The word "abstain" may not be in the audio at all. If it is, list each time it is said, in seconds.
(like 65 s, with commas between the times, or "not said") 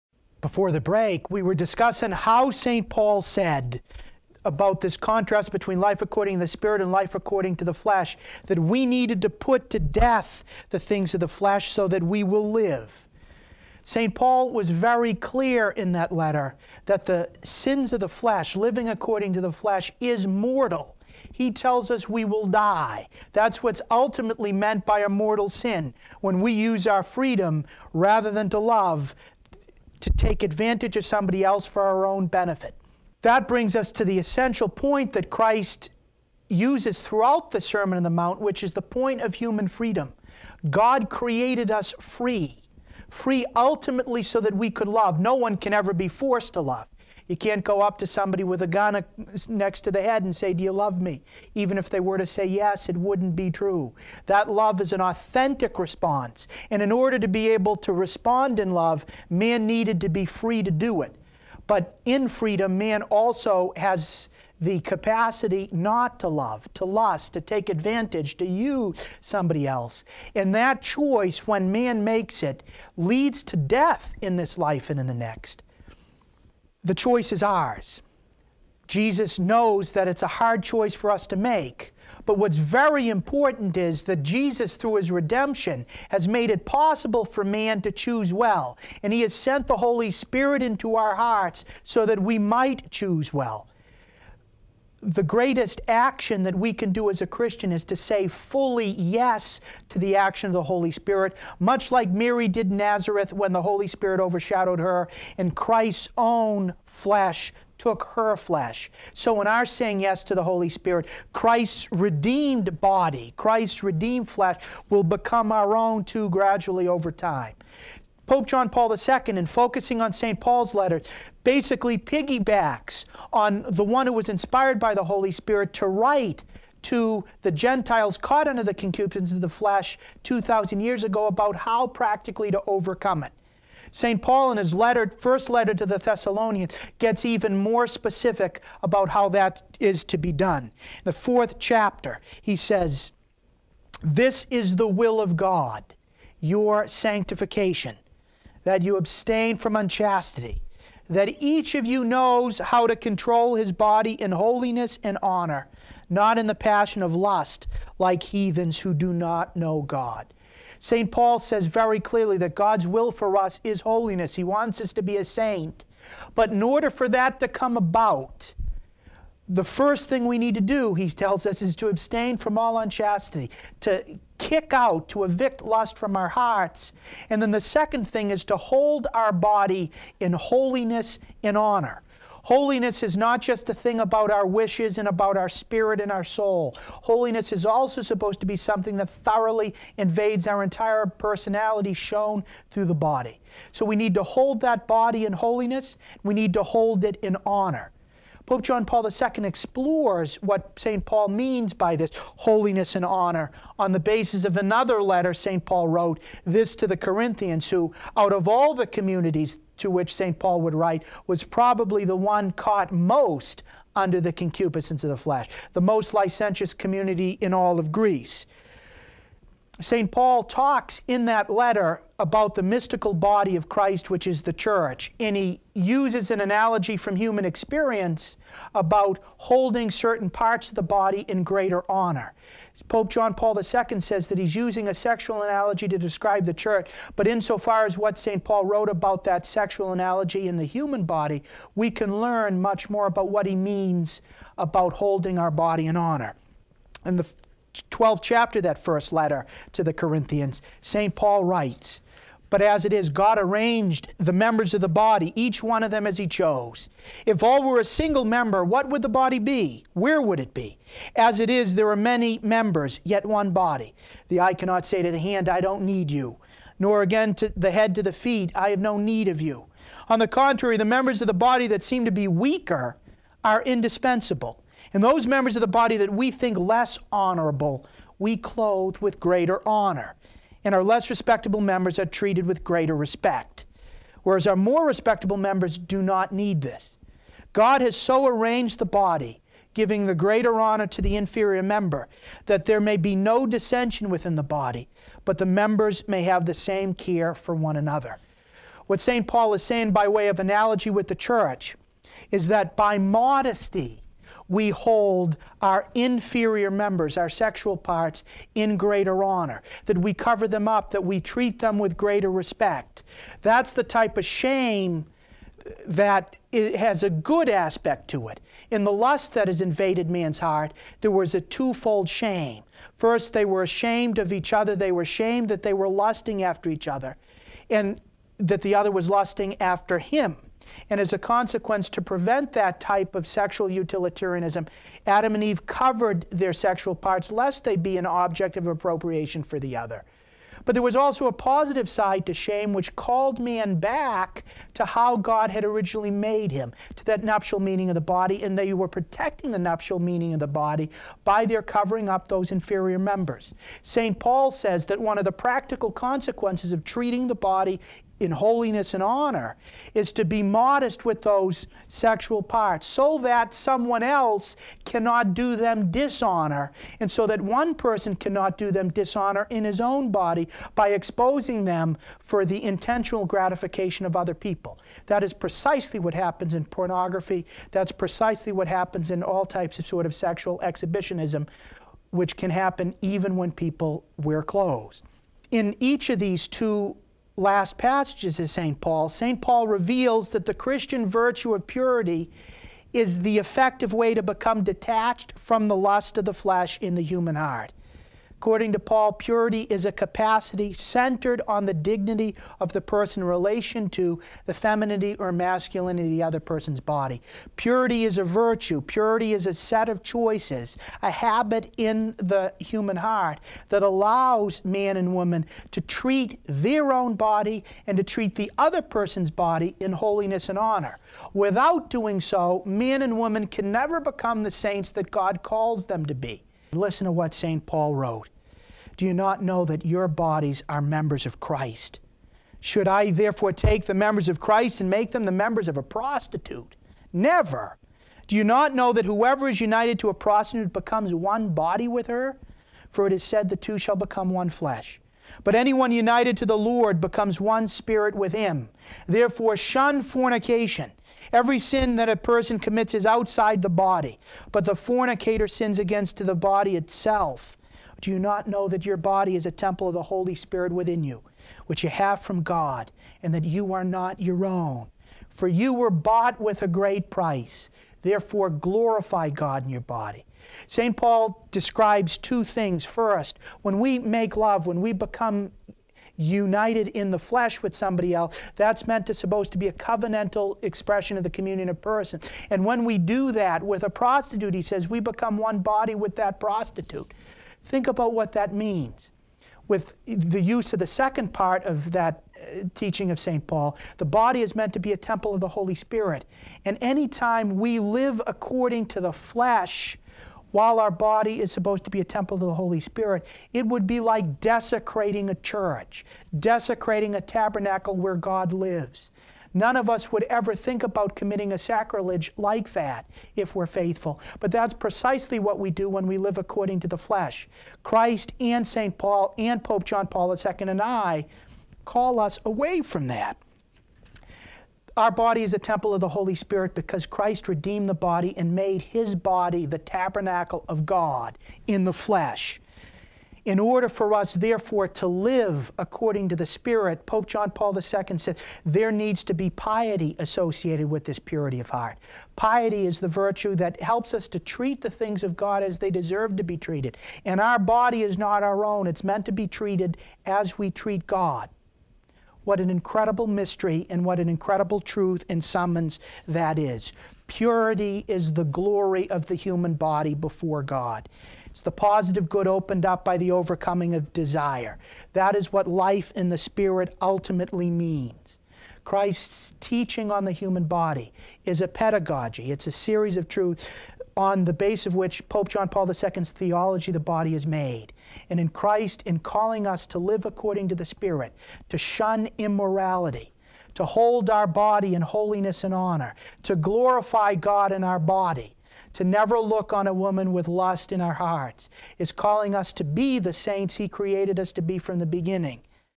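148 s, 171 s.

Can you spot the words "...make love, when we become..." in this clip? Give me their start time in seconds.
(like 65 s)
473 s.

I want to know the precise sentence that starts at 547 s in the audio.
And our body is not our own, it's meant to be treated as we treat God.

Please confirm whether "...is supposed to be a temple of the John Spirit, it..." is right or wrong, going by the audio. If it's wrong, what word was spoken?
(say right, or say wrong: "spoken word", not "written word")
wrong: "Holy", not "John".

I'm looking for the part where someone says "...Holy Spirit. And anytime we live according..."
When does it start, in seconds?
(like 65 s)
495 s.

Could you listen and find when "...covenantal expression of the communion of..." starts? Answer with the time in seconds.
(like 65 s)
479 s.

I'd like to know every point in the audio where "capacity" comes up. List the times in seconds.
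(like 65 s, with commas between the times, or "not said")
64 s, 399 s.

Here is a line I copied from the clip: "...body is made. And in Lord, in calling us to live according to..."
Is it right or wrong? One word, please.
wrong.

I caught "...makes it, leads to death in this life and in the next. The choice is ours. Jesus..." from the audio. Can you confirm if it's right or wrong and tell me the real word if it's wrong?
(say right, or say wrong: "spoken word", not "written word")
right.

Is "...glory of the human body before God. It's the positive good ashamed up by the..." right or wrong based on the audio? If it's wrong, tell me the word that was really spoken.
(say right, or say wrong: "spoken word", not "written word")
wrong: "opened", not "ashamed".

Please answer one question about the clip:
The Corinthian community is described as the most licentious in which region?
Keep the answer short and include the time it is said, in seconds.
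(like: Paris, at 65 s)
Greece, at 217 s.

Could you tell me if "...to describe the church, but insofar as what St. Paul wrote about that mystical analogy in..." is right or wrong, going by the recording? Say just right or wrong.
wrong.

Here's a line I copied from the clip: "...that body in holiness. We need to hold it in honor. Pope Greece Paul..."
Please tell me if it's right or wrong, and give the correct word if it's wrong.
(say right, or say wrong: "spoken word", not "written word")
wrong: "John", not "Greece".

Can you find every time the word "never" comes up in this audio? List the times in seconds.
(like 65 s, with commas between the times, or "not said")
423 s, 437 s, 589 s.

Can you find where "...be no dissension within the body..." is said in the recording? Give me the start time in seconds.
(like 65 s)
292 s.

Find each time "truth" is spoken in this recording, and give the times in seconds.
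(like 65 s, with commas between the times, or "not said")
554 s, 573 s.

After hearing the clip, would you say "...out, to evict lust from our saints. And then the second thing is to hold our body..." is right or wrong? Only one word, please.
wrong.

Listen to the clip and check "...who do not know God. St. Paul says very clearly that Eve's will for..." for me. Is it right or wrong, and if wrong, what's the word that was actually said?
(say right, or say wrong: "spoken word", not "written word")
wrong: "God", not "Eve".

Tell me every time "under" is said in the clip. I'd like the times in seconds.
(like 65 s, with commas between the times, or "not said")
128 s, 213 s.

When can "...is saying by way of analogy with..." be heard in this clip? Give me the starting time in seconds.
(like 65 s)
299 s.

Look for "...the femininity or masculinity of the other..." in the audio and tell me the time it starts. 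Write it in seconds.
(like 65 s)
404 s.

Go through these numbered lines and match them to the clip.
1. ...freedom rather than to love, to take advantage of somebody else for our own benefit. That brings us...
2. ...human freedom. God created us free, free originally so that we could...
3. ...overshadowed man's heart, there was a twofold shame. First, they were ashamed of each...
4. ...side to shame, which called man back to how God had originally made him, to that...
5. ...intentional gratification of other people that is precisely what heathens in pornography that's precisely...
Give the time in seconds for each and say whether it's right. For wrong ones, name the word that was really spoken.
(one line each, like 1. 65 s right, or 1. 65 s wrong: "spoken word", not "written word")
1. 27 s right
2. 39 s wrong: "ultimately", not "originally"
3. 319 s wrong: "invaded", not "overshadowed"
4. 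341 s right
5. 372 s wrong: "happens", not "heathens".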